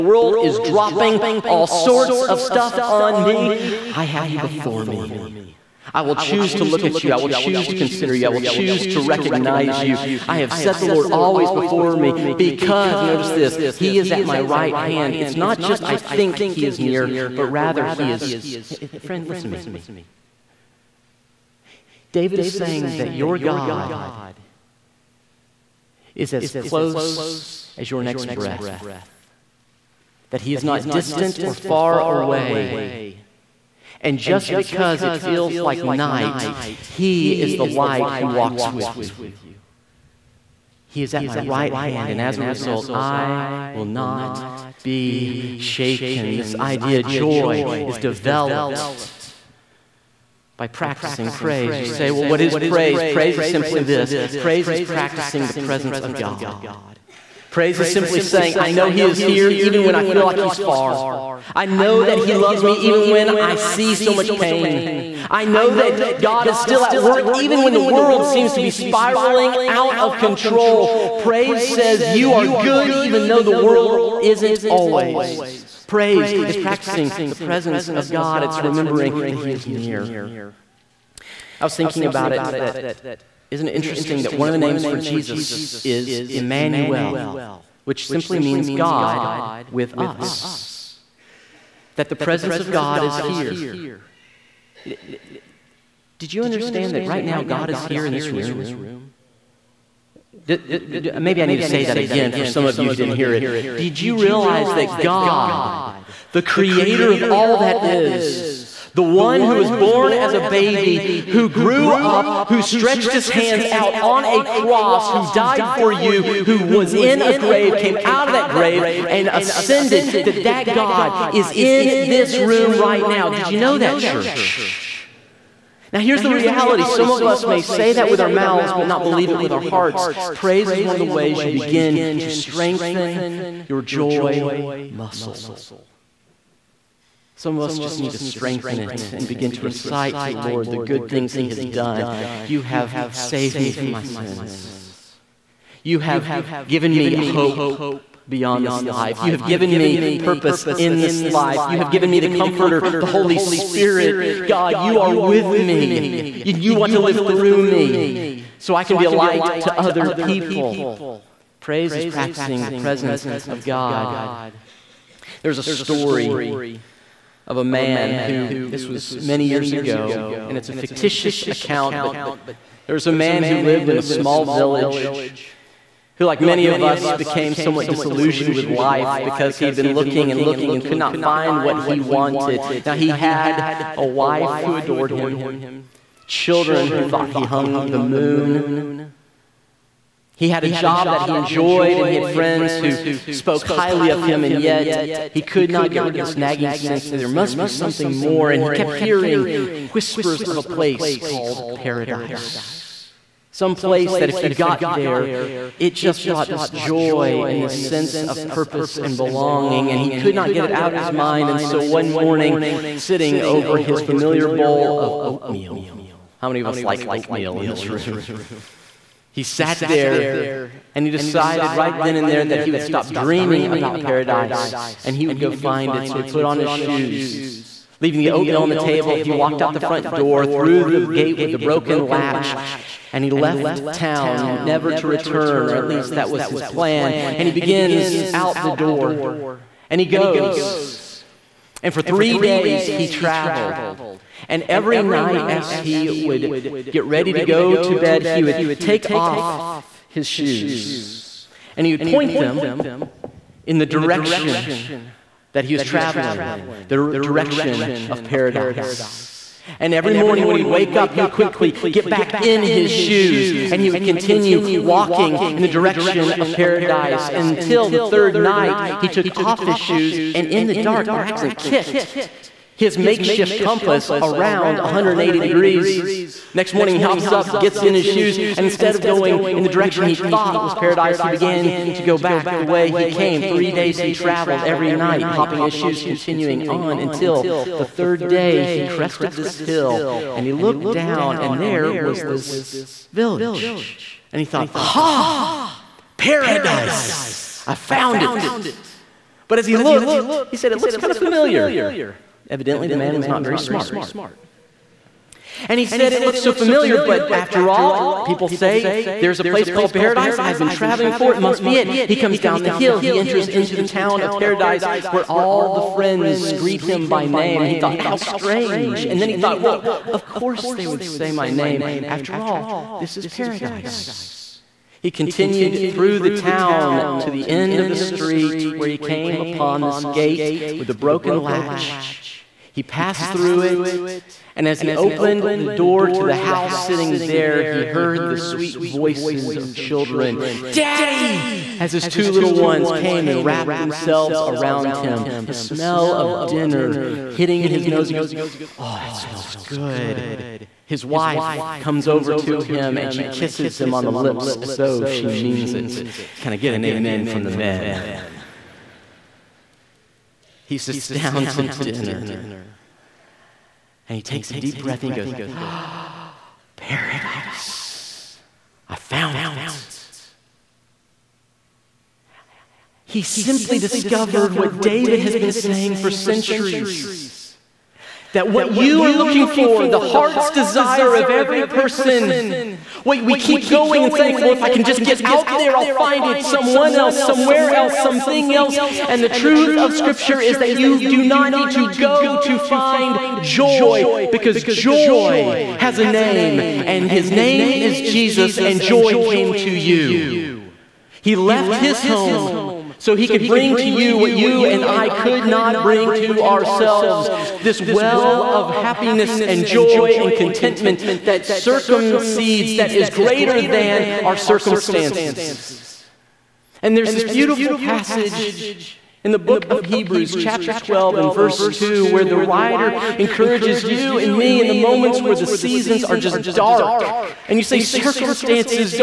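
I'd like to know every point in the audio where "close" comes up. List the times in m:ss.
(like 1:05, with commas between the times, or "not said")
0:26.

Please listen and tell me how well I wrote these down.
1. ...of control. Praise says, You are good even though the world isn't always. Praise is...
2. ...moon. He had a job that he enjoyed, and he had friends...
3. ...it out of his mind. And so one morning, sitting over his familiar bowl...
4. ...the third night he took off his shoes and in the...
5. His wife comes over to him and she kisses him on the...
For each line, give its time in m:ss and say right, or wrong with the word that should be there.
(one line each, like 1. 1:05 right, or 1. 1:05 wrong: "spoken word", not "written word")
1. 1:09 right
2. 3:07 right
3. 3:30 right
4. 4:27 right
5. 5:50 right.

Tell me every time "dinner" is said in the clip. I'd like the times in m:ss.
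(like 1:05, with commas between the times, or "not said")
5:46, 6:01.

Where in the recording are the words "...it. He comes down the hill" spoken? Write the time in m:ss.
5:11.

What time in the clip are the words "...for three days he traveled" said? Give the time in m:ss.
4:01.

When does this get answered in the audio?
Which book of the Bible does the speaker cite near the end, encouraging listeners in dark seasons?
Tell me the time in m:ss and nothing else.
6:59.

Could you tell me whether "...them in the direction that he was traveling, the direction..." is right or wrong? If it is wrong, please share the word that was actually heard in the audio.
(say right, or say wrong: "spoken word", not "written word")
right.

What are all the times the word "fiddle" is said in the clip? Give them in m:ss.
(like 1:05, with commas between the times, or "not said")
not said.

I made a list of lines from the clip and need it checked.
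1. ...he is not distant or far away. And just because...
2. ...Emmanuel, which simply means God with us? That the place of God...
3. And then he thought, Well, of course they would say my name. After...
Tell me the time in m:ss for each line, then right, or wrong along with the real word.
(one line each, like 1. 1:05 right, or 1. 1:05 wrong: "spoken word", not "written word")
1. 0:30 right
2. 1:26 wrong: "presence", not "place"
3. 5:19 right.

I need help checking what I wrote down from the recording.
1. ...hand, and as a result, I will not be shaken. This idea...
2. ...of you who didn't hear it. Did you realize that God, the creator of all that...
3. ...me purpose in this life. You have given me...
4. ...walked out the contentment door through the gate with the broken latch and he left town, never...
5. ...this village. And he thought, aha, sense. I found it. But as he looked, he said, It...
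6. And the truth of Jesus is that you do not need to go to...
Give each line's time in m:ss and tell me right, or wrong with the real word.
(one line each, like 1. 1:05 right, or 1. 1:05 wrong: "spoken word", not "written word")
1. 0:41 right
2. 1:42 right
3. 2:29 right
4. 3:49 wrong: "front", not "contentment"
5. 4:52 wrong: "paradise", not "sense"
6. 6:29 wrong: "Scripture", not "Jesus".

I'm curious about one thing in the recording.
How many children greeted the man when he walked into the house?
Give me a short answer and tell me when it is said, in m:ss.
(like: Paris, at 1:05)
2, at 5:42.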